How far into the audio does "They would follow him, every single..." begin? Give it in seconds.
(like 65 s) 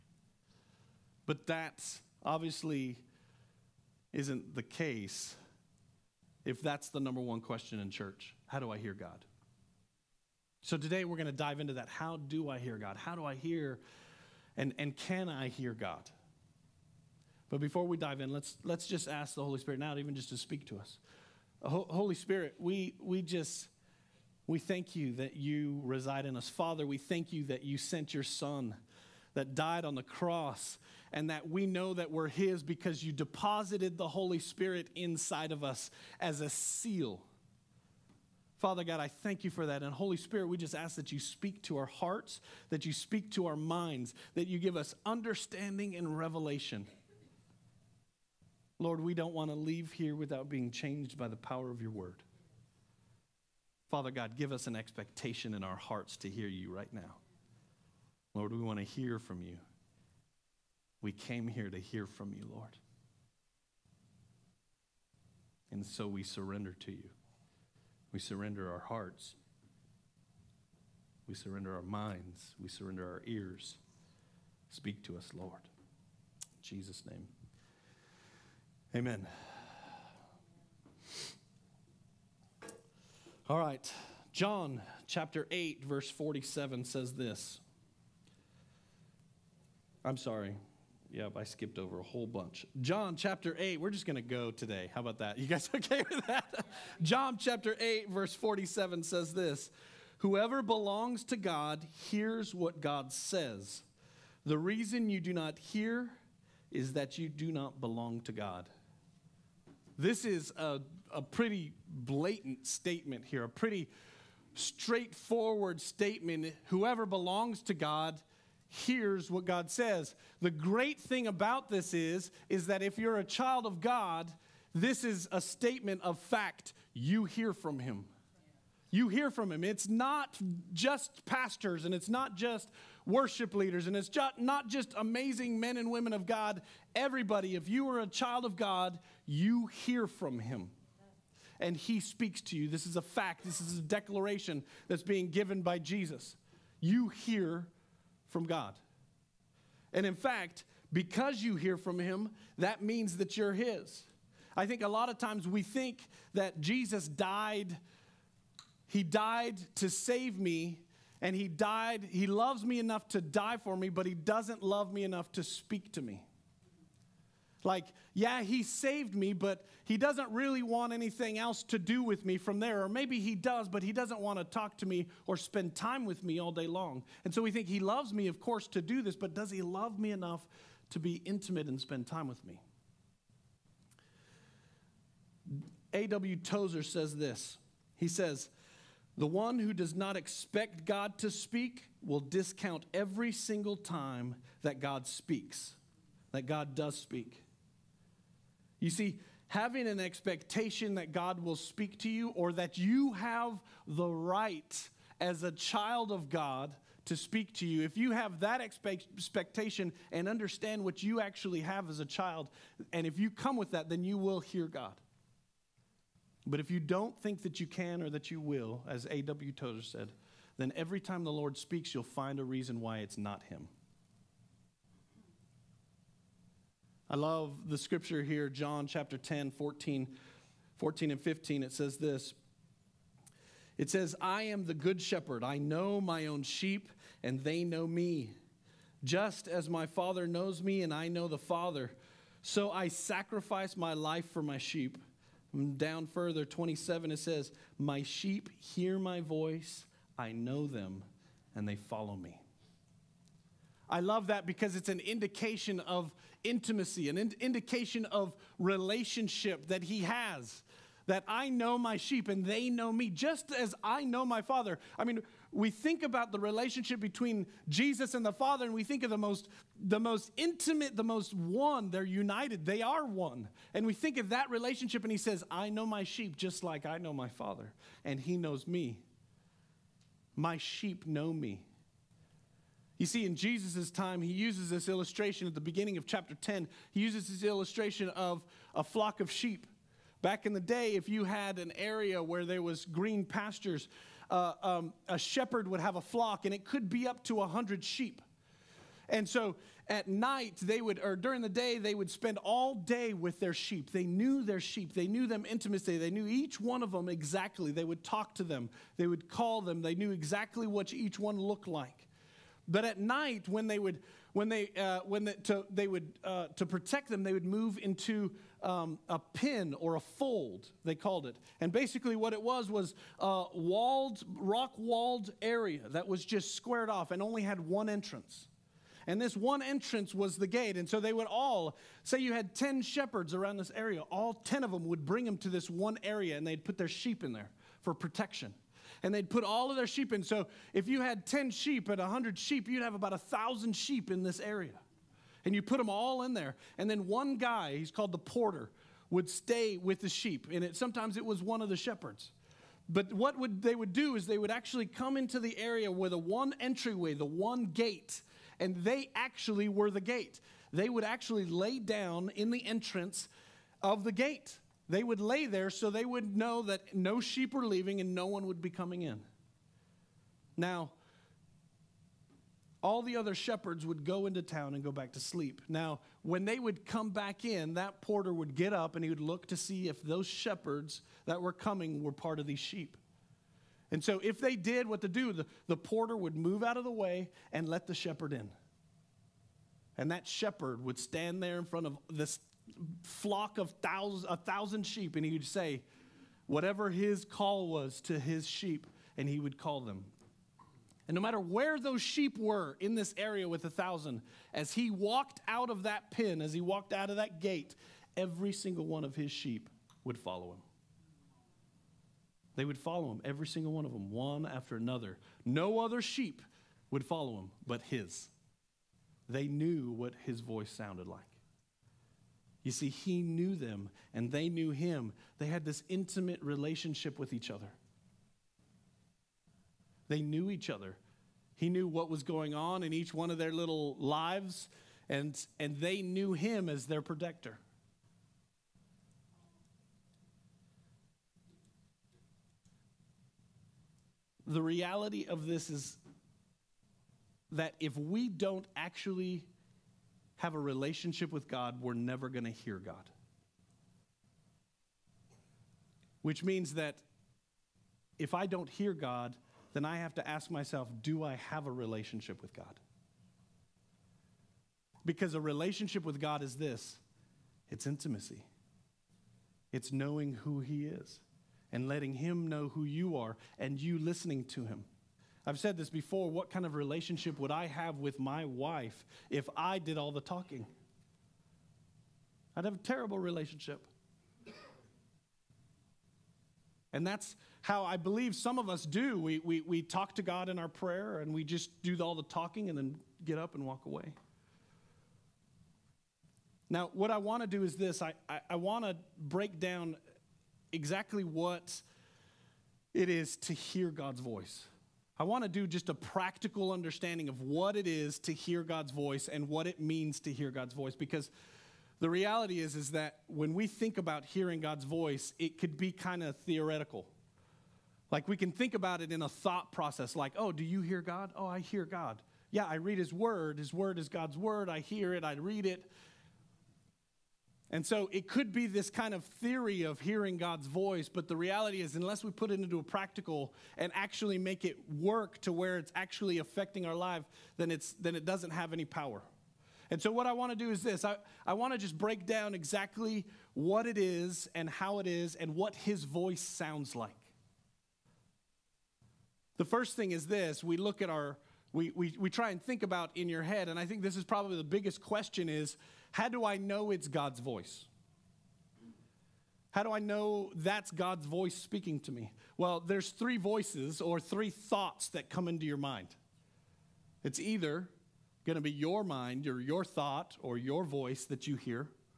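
412 s.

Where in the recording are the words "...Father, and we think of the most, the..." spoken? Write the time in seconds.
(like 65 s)
268 s.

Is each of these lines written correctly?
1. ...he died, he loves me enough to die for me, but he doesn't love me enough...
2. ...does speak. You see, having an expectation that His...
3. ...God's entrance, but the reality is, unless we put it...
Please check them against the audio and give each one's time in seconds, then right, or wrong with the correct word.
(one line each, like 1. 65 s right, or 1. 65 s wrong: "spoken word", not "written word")
1. 161 s right
2. 196 s wrong: "God", not "His"
3. 530 s wrong: "voice", not "entrance".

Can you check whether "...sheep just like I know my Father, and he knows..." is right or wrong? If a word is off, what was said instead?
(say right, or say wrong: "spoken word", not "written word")
right.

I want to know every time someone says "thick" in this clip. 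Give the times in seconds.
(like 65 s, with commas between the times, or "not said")
not said.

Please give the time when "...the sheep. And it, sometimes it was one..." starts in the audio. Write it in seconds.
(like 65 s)
350 s.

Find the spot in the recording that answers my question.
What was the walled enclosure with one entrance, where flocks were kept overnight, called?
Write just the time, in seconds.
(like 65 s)
319 s.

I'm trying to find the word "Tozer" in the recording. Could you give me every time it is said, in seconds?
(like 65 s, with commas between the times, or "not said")
186 s, 219 s.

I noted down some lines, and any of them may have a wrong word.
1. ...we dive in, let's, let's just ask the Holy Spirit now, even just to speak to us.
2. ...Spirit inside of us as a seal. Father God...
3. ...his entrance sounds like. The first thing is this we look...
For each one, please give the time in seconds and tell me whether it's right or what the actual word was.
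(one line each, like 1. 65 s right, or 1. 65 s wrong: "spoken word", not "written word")
1. 17 s right
2. 34 s right
3. 545 s wrong: "voice", not "entrance".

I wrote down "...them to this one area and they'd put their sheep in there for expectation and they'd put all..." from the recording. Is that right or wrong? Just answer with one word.
wrong.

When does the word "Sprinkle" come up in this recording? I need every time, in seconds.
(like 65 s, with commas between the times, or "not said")
not said.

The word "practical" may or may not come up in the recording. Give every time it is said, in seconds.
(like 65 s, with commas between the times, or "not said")
505 s, 532 s.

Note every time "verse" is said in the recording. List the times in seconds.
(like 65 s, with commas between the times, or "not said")
85 s, 98 s.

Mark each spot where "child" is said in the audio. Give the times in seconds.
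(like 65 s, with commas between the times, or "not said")
123 s, 138 s, 205 s, 212 s.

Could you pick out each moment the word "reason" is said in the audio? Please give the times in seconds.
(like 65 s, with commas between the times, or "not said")
104 s, 222 s.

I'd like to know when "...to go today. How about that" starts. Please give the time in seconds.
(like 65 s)
94 s.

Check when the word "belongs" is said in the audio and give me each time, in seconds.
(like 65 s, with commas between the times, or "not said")
100 s, 107 s, 117 s.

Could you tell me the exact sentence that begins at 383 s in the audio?
And so, if they did what to do, the, the porter would move out of the way and let the shepherd in.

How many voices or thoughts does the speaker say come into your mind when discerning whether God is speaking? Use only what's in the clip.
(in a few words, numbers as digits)
3.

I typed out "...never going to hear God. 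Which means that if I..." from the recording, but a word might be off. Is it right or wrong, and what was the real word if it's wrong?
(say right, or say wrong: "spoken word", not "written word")
right.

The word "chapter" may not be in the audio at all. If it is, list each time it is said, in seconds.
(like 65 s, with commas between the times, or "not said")
85 s, 93 s, 97 s, 228 s, 286 s.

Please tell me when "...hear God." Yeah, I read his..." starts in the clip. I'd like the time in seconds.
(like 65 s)
521 s.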